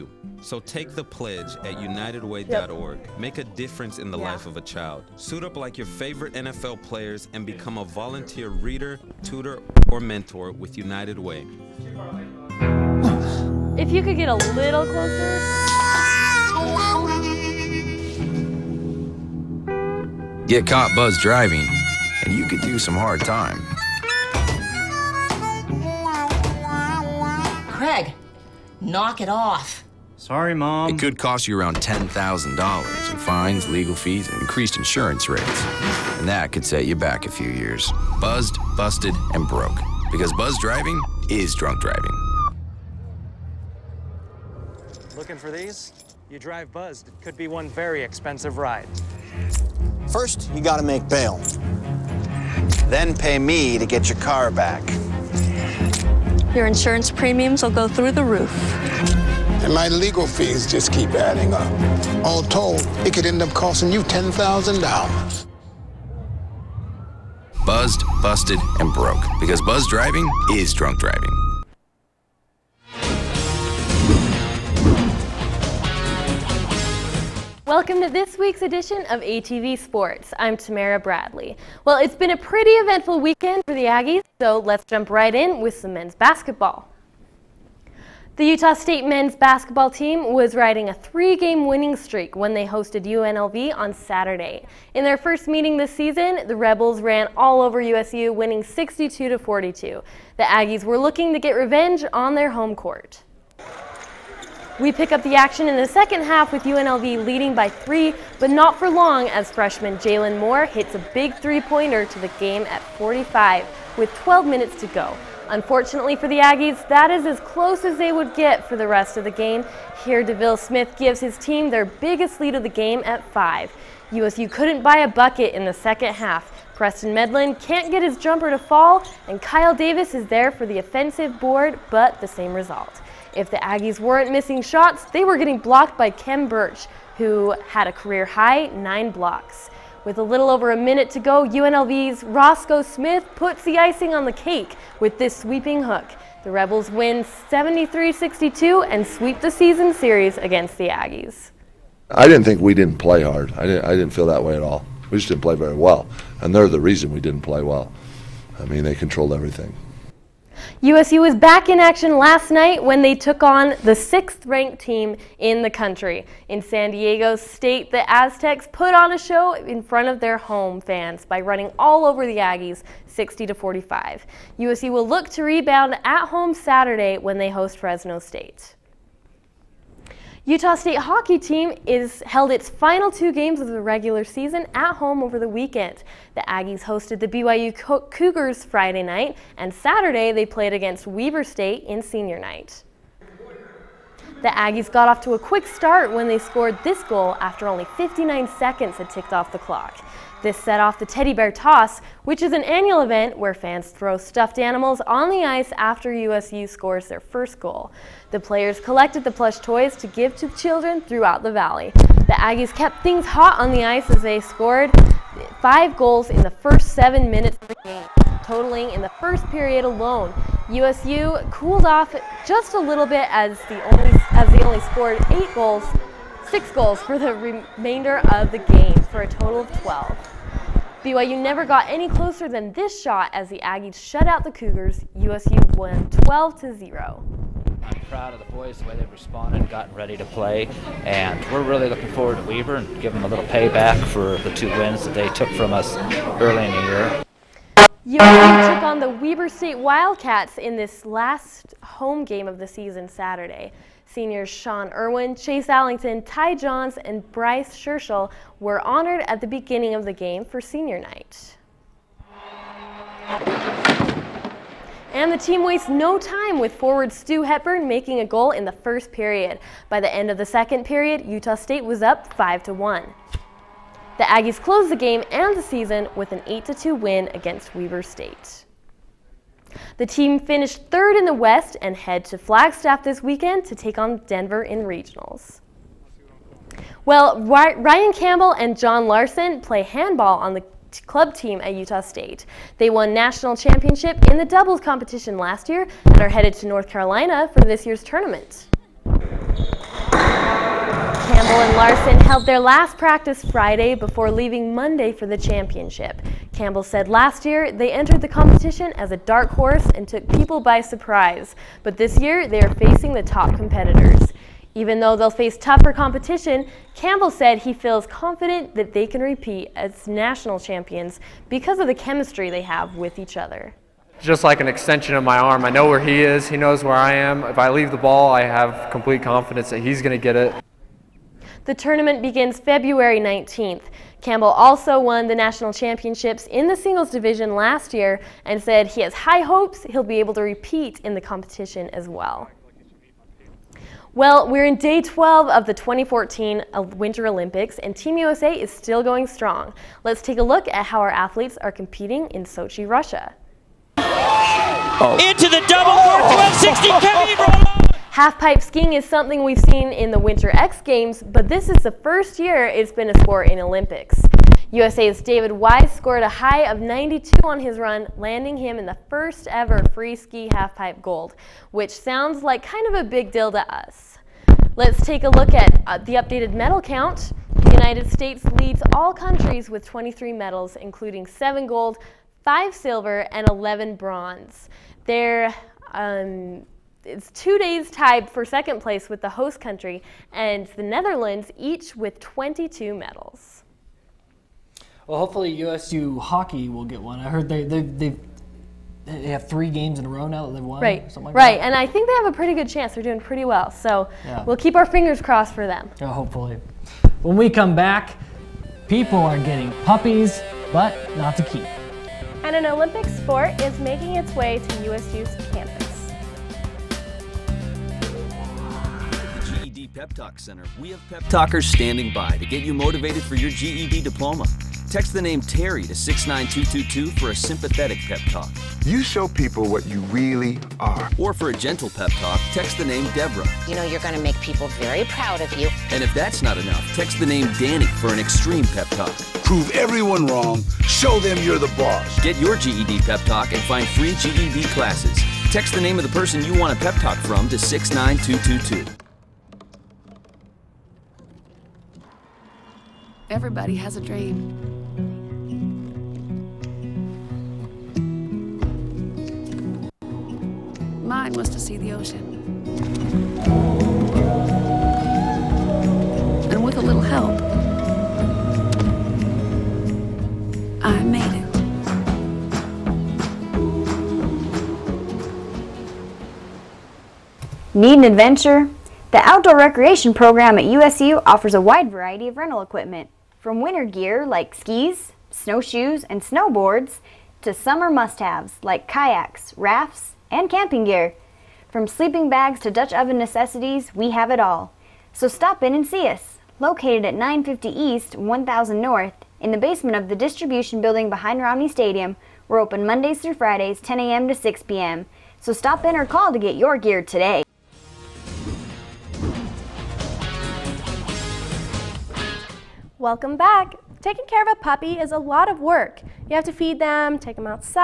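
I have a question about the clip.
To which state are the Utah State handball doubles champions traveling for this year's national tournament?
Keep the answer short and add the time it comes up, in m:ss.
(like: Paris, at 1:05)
North Carolina, at 4:56.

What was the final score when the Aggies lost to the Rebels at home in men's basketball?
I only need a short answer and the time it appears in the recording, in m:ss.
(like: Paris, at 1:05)
73-62, at 2:27.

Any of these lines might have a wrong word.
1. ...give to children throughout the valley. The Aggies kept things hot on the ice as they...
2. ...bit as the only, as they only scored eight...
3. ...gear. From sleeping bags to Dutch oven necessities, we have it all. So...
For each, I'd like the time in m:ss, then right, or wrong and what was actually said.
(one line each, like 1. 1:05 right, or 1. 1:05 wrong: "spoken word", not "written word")
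1. 3:30 right
2. 3:43 right
3. 8:10 right.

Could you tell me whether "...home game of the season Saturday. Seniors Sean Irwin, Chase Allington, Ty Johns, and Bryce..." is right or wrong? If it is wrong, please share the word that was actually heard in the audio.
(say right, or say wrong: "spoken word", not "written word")
right.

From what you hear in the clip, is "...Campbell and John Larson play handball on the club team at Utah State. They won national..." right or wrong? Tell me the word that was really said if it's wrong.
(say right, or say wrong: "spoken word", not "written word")
right.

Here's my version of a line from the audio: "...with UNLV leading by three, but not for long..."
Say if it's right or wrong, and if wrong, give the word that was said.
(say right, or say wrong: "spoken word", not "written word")
right.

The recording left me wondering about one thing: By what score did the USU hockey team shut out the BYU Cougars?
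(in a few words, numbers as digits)
12 to 0.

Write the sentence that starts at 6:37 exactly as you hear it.
I heard they they they they have three games in a row now that they've won.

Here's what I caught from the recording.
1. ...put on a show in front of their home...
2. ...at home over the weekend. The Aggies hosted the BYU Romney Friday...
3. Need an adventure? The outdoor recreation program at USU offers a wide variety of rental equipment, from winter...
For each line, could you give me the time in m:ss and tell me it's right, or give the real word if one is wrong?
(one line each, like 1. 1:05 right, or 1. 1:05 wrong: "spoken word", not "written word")
1. 2:48 right
2. 3:04 wrong: "Cougars", not "Romney"
3. 7:57 right.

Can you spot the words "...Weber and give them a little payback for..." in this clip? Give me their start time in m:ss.
4:02.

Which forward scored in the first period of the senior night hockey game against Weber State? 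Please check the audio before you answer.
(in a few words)
Stu Hepburn.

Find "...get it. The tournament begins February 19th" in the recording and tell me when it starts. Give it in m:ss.
5:30.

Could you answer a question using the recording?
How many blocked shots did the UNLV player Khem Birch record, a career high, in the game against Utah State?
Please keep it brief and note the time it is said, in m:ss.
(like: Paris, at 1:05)
9, at 2:18.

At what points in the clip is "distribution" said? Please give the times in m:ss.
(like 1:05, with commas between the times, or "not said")
8:20.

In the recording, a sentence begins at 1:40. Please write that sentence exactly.
The Aggies were looking to get revenge on their home court.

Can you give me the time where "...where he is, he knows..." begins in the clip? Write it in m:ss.
5:25.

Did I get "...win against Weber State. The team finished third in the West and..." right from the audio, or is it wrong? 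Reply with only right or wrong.
right.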